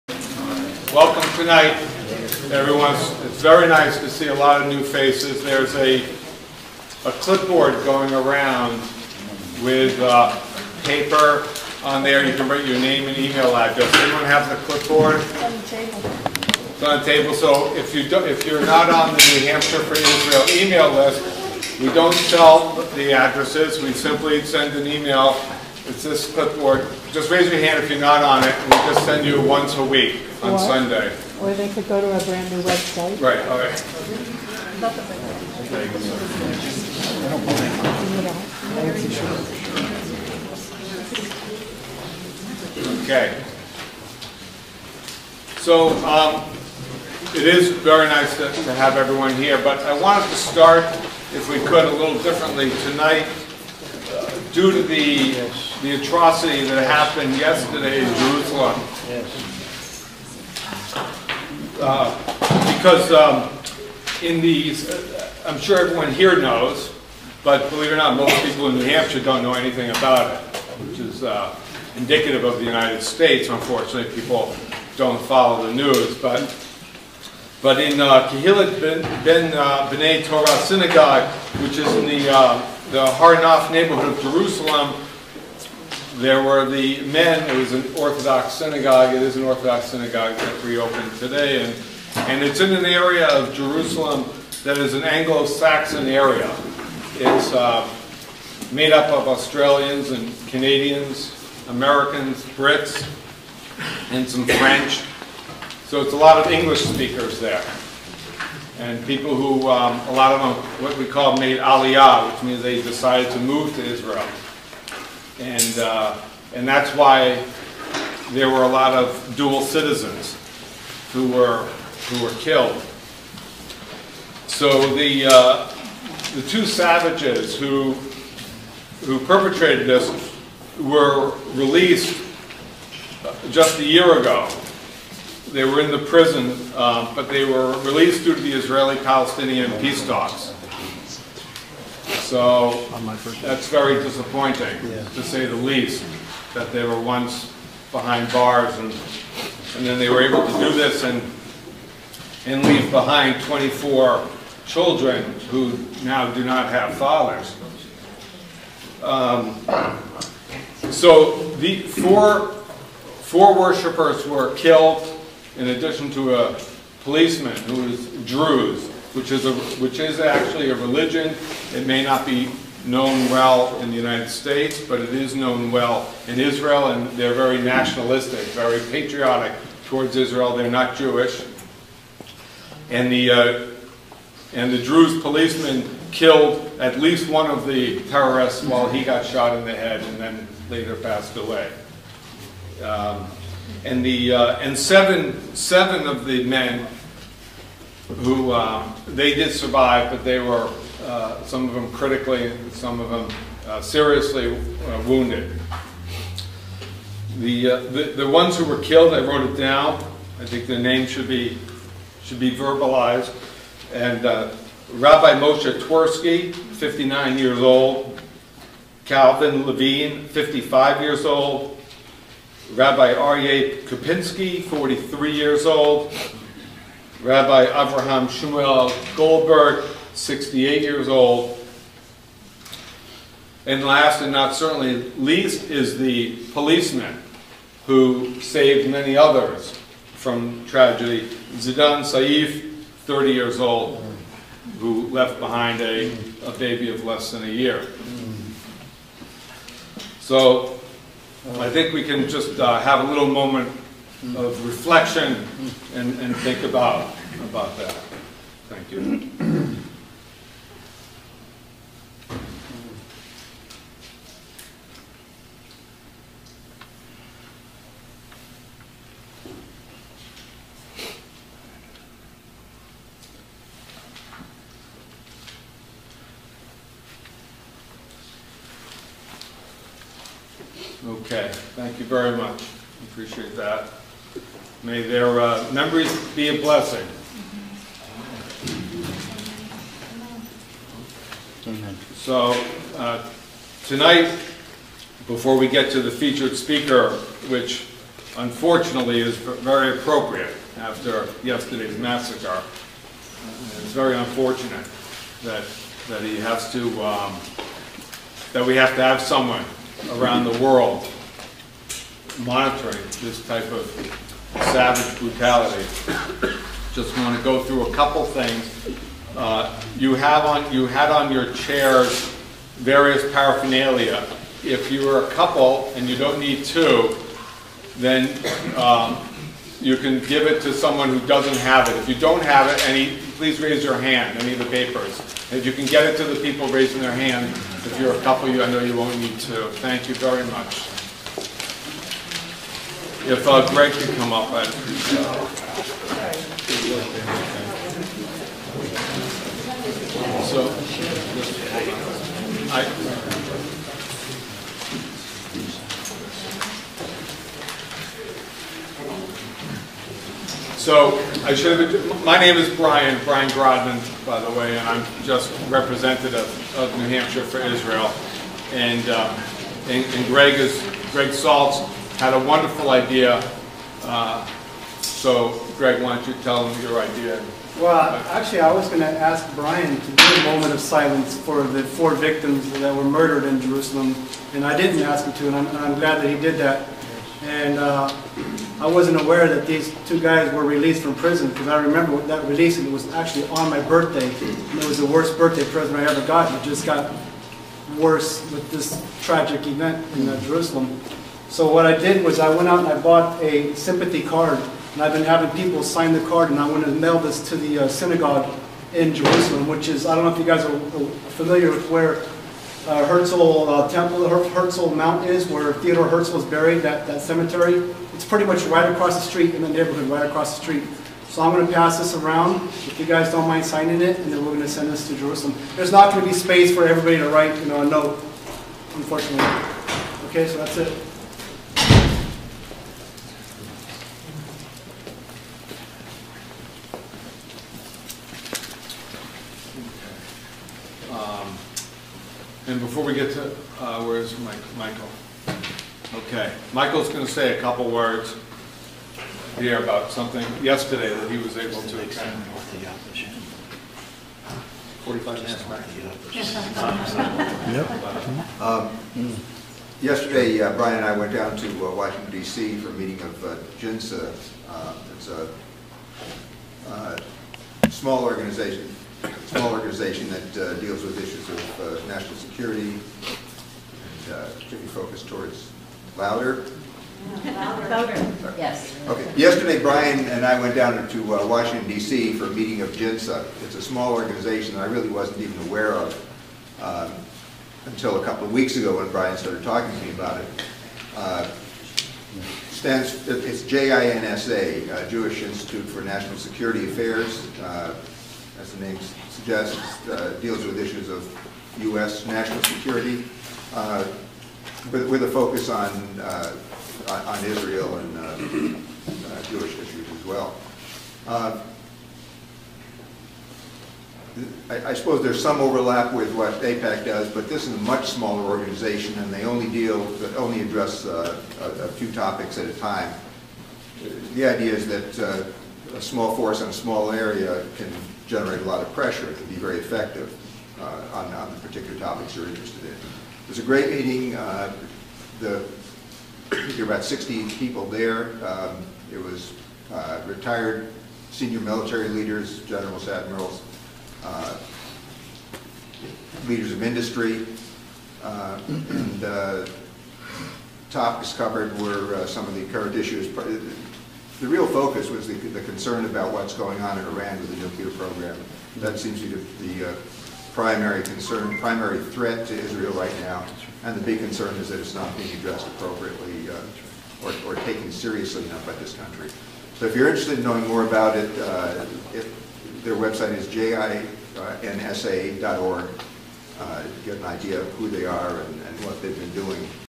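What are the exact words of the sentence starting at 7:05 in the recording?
There's not going to be space for everybody to write you know, a note, unfortunately.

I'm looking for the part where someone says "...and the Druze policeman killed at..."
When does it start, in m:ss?
3:04.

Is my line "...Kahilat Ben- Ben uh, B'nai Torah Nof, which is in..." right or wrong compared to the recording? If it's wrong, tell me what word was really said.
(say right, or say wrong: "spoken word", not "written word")
wrong: "Synagogue", not "Nof".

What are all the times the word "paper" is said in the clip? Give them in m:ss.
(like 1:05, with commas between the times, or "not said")
0:10, 5:34.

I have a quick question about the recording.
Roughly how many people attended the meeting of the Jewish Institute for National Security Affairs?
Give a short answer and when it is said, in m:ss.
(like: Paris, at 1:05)
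60, at 8:57.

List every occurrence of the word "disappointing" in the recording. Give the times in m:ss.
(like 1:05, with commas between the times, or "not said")
2:24.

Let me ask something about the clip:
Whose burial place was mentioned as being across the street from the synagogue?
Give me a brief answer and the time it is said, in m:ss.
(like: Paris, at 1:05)
Theodore Herzl, at 6:55.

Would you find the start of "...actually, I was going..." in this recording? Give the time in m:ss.
6:18.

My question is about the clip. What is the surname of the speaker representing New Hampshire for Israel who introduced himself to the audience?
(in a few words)
Grodman.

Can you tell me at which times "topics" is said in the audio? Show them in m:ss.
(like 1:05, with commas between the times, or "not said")
8:42, 8:51, 9:10.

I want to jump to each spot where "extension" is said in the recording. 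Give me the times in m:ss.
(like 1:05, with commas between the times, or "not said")
not said.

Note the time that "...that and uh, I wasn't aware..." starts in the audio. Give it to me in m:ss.
6:26.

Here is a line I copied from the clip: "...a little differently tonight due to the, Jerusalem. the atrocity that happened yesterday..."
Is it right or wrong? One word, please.
wrong.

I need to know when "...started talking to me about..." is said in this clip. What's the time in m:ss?
8:09.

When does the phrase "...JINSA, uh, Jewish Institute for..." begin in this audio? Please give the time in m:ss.
8:13.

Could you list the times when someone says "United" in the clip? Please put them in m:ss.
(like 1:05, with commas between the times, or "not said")
1:12, 2:53.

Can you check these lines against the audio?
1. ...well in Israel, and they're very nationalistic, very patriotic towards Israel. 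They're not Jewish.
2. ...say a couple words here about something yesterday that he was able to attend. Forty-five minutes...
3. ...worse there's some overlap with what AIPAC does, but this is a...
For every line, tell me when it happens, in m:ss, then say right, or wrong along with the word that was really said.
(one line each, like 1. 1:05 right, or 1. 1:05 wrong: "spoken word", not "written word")
1. 2:55 right
2. 7:27 right
3. 8:34 wrong: "suppose", not "worse".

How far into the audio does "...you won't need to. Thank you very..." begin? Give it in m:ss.
5:38.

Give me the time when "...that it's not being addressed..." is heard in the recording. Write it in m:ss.
9:24.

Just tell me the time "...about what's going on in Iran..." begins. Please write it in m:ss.
9:16.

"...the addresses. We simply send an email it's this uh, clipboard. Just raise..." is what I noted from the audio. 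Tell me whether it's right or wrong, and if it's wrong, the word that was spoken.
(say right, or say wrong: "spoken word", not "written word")
right.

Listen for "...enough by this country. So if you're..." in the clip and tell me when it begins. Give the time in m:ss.
9:28.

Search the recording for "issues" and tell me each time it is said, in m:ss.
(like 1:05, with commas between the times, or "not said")
7:51, 8:20, 8:29, 9:12.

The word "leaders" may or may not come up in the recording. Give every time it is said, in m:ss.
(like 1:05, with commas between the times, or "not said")
9:02, 9:06.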